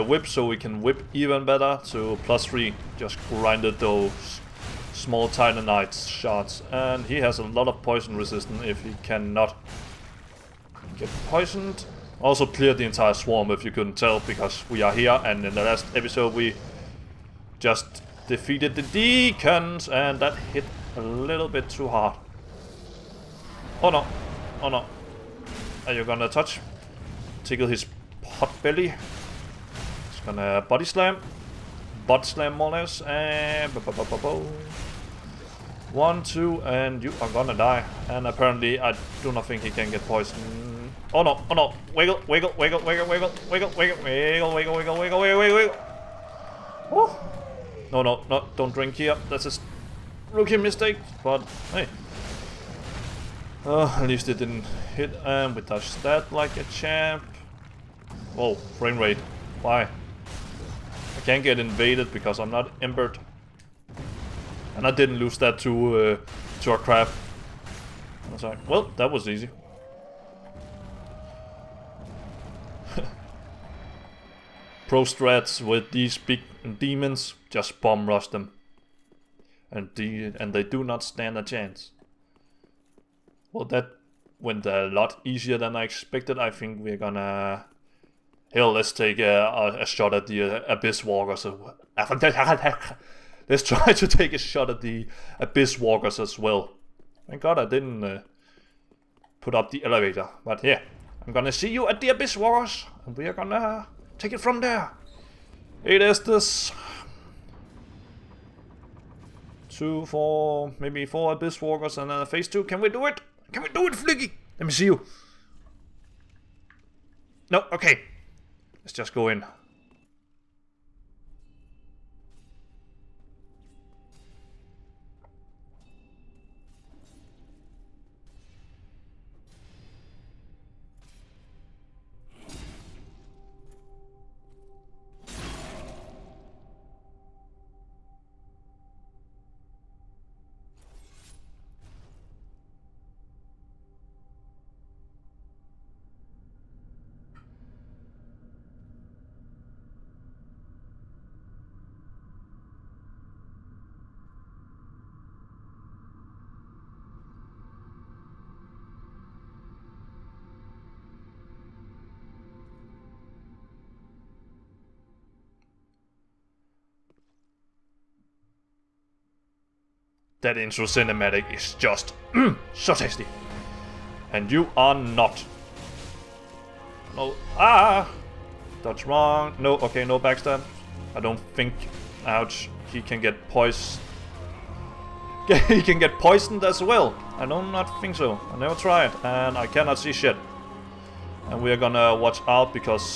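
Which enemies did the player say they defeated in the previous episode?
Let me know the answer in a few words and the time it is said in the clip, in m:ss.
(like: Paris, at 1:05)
The deacons, at 0:18.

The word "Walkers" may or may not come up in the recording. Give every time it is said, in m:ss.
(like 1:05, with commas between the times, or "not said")
1:31, 1:35, 1:42, 1:51.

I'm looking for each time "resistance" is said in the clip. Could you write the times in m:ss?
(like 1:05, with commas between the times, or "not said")
0:08.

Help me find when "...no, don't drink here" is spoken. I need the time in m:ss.
0:48.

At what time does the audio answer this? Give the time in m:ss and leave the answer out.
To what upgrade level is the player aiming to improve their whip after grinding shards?
0:02.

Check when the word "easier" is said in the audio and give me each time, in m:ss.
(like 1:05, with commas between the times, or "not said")
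1:25.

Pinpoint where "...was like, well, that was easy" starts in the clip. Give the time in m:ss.
1:08.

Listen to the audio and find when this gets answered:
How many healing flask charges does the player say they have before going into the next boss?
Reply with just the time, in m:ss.
1:45.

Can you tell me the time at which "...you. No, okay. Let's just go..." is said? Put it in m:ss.
1:54.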